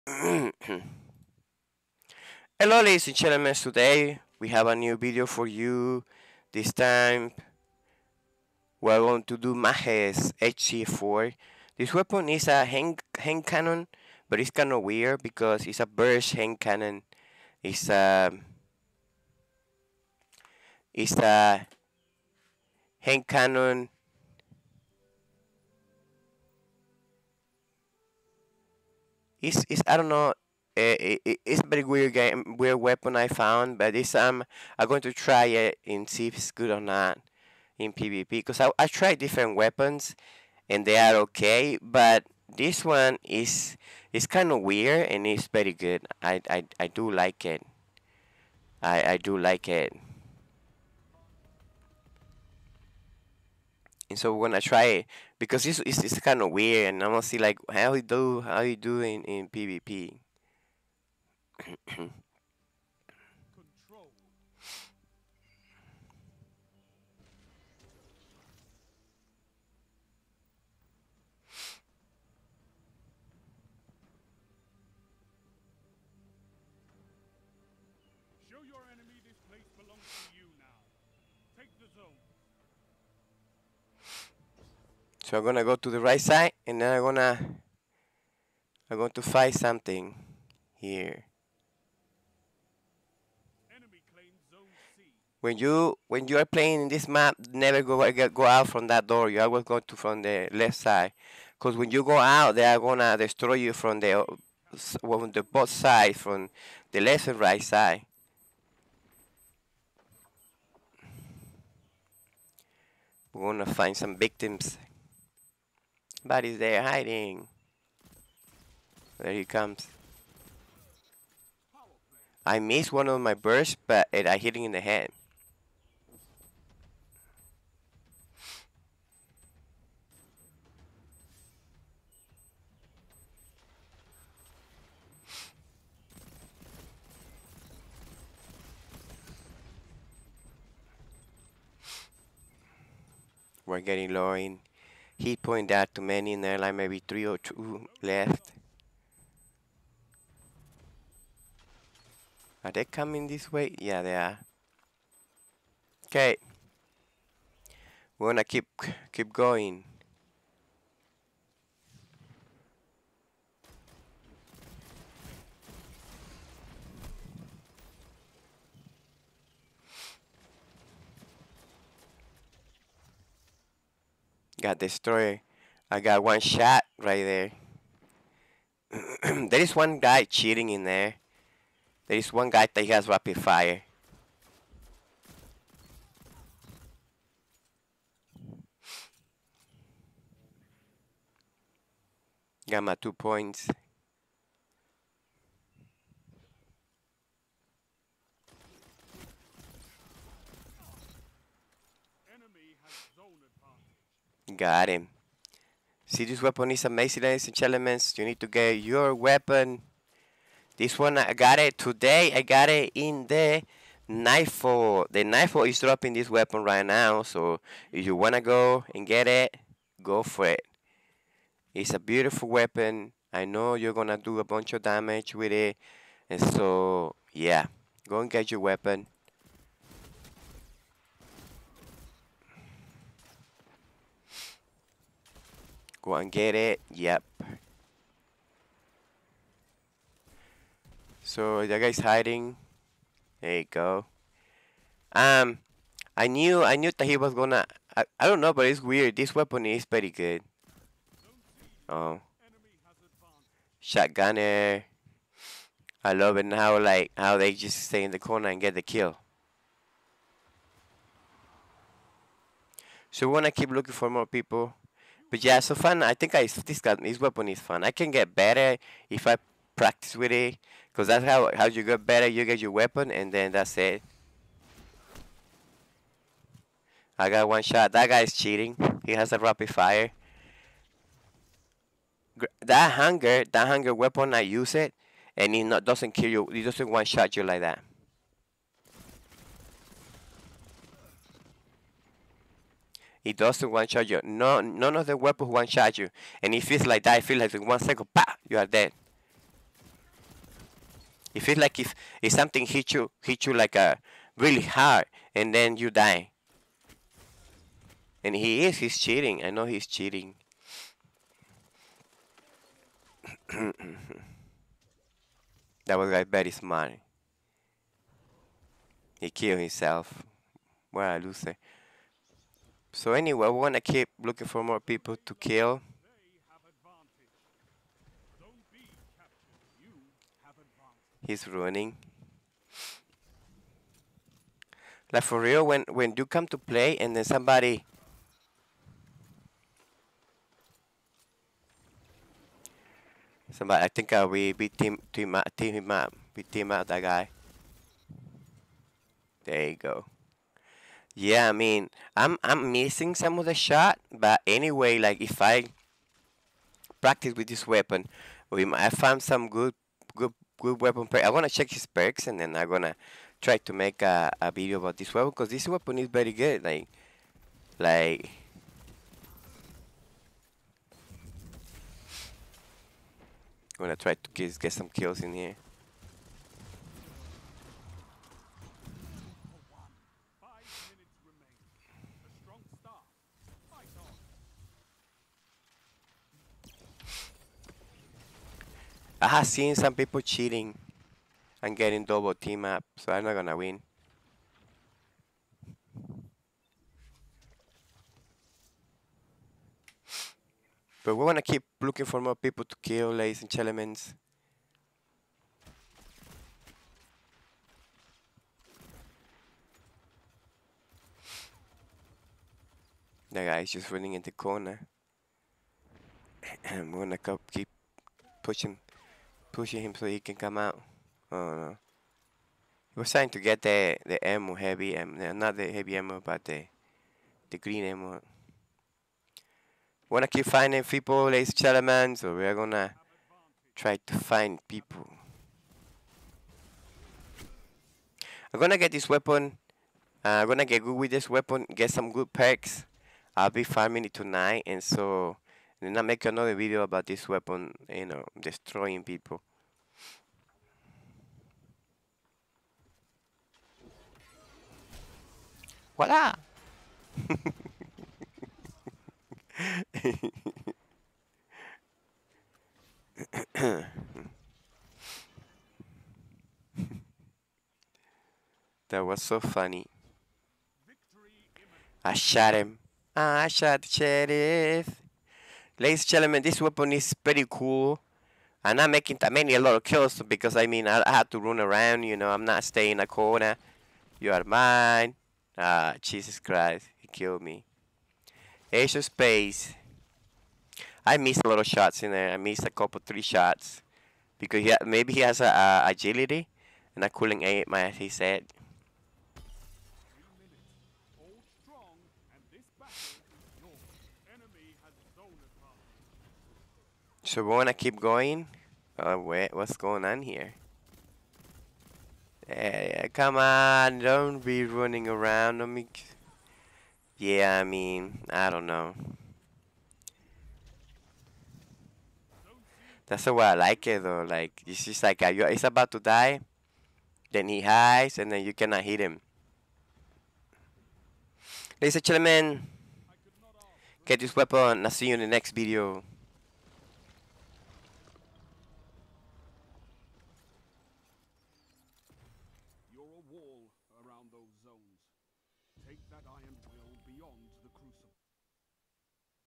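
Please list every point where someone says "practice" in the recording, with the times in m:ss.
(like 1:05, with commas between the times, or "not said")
4:29, 5:57.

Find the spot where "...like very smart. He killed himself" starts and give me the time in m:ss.
5:16.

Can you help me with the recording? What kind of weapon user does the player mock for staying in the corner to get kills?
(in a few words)
Shotgunner.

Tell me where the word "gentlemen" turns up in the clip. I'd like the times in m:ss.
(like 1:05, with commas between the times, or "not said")
0:03, 3:27, 6:43, 7:11, 7:56, 8:52.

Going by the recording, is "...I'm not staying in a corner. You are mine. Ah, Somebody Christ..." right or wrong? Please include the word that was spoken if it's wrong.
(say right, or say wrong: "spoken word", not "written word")
wrong: "Jesus", not "Somebody".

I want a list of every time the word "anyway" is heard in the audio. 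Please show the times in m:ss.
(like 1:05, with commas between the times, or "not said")
5:23, 5:54.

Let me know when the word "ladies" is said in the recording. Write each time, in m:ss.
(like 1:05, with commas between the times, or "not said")
0:02, 3:27, 6:43, 7:11, 7:55, 8:51.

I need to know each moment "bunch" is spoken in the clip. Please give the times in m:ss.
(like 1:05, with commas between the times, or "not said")
3:44.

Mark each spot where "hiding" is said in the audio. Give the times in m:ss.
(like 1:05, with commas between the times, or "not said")
1:56, 4:01.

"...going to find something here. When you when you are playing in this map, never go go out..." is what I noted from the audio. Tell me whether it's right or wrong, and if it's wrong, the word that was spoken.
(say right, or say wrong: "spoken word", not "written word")
right.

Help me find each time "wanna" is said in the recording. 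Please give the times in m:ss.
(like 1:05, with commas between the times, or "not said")
4:23, 7:10, 8:27.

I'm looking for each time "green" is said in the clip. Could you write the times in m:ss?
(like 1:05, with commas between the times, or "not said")
7:07.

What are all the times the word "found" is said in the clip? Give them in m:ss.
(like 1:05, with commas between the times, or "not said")
0:33, 5:58.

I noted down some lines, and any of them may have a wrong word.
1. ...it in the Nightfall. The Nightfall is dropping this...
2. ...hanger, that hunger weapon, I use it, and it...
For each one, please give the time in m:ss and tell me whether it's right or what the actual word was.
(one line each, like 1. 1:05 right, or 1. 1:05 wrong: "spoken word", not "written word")
1. 3:32 right
2. 4:42 right.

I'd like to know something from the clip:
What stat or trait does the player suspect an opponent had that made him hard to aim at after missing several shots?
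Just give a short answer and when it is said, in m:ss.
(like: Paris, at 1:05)
Agility, at 8:15.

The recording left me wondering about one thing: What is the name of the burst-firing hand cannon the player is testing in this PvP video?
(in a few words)
Mages HC4.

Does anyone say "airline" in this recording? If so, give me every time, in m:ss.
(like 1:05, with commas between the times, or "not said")
2:26.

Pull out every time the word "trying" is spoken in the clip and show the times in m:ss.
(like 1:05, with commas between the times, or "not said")
7:03.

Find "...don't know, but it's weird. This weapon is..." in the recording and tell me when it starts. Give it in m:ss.
4:08.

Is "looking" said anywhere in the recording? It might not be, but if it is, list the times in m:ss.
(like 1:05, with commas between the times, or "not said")
4:23, 5:24, 6:41.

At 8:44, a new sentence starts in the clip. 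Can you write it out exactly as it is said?
Like it's just like a, it's about to die, then he hides, and then you cannot hit him.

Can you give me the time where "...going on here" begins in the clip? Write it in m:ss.
8:29.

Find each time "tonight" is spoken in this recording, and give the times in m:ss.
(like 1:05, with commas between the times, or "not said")
7:24.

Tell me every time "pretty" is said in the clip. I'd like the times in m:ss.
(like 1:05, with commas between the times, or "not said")
4:09, 7:57.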